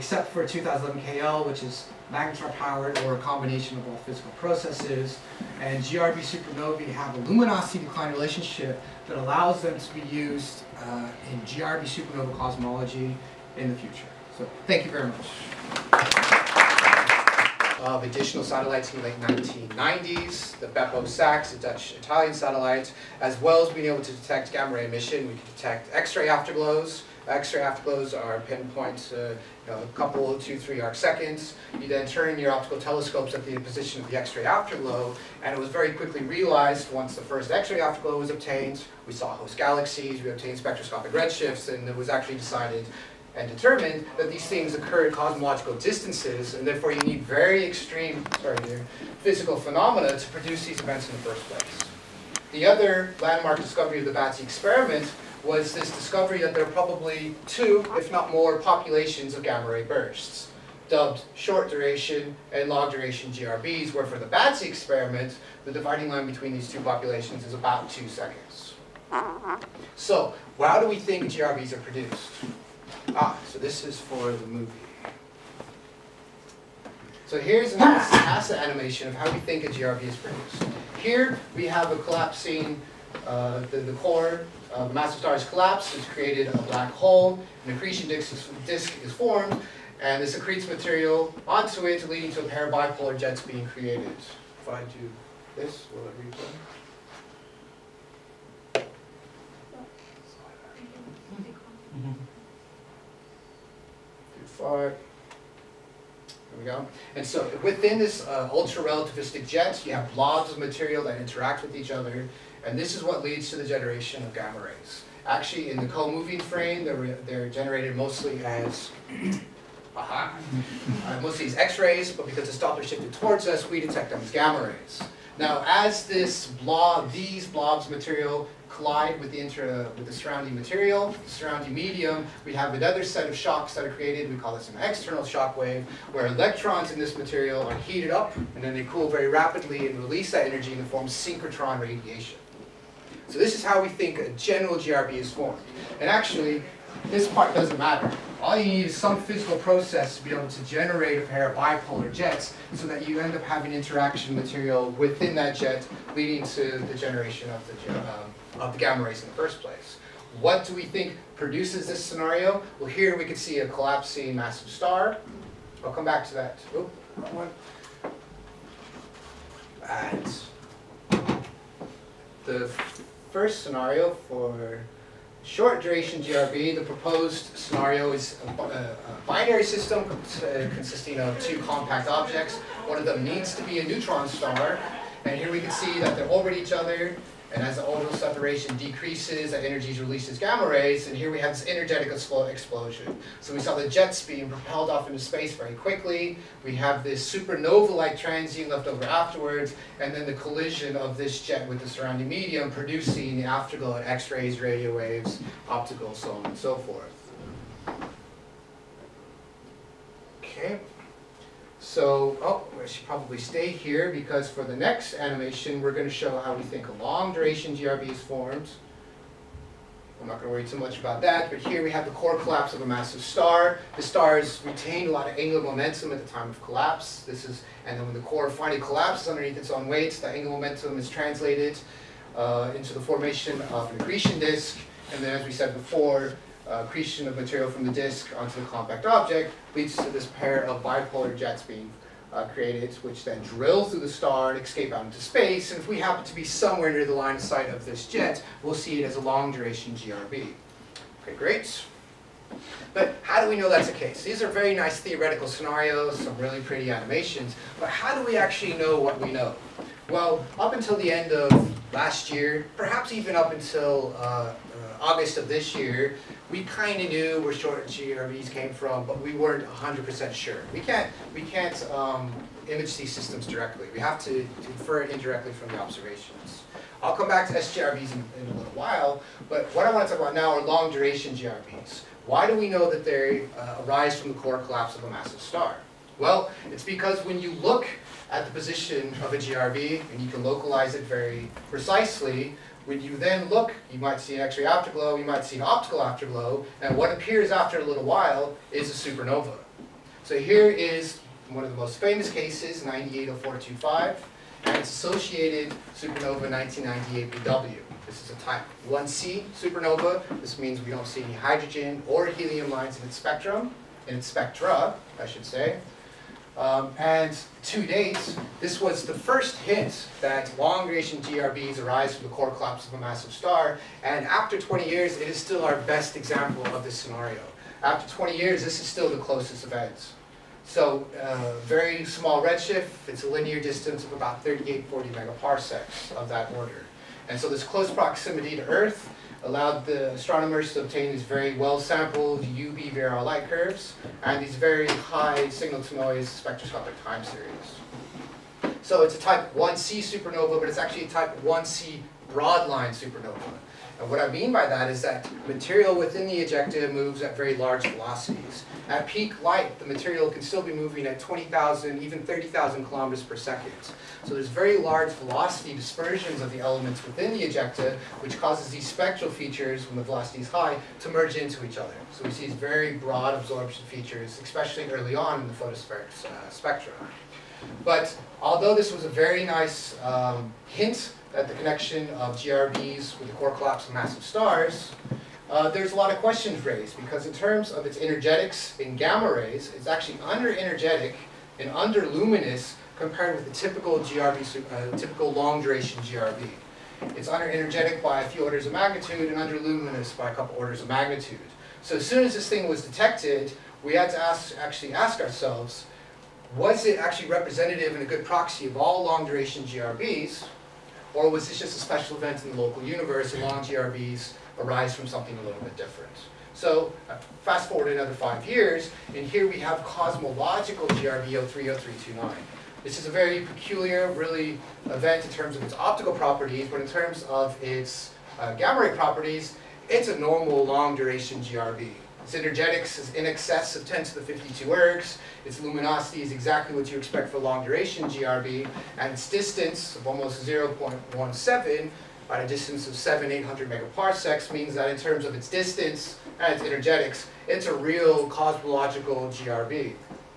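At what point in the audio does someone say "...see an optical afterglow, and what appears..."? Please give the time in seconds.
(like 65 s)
295 s.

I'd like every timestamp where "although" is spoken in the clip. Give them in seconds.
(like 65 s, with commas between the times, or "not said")
378 s.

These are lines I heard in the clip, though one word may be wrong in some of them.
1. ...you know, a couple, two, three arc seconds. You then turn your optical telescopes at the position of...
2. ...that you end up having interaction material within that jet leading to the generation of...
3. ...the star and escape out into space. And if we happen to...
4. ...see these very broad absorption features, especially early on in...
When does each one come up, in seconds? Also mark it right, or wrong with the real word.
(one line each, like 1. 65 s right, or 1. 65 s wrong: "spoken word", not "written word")
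1. 29 s right
2. 152 s right
3. 244 s right
4. 372 s right.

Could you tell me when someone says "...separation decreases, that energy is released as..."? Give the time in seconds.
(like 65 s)
188 s.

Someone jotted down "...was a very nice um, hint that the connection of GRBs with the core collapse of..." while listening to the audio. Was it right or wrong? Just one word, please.
right.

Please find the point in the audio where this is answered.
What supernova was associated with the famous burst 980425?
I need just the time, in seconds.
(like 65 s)
305 s.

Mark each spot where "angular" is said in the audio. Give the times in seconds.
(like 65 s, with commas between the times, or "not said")
225 s, 230 s.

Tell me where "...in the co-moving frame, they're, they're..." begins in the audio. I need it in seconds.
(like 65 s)
115 s.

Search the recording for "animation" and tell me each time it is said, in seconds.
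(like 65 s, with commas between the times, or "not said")
78 s, 215 s, 256 s.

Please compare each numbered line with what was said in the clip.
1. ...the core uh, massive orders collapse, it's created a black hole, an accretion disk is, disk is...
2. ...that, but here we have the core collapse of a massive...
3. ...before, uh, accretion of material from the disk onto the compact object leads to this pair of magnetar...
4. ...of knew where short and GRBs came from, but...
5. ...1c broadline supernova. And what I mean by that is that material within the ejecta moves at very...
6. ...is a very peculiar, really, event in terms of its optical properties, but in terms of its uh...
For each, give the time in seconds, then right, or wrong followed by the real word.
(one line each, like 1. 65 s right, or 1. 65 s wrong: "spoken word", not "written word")
1. 83 s wrong: "stars", not "orders"
2. 221 s right
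3. 235 s wrong: "bipolar", not "magnetar"
4. 267 s right
5. 351 s right
6. 422 s right.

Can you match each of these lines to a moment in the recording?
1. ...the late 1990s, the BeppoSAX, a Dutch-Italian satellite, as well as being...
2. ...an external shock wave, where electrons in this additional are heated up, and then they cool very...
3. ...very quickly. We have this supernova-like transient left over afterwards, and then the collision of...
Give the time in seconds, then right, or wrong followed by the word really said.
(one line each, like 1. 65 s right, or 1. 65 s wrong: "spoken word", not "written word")
1. 19 s right
2. 134 s wrong: "material", not "additional"
3. 195 s right.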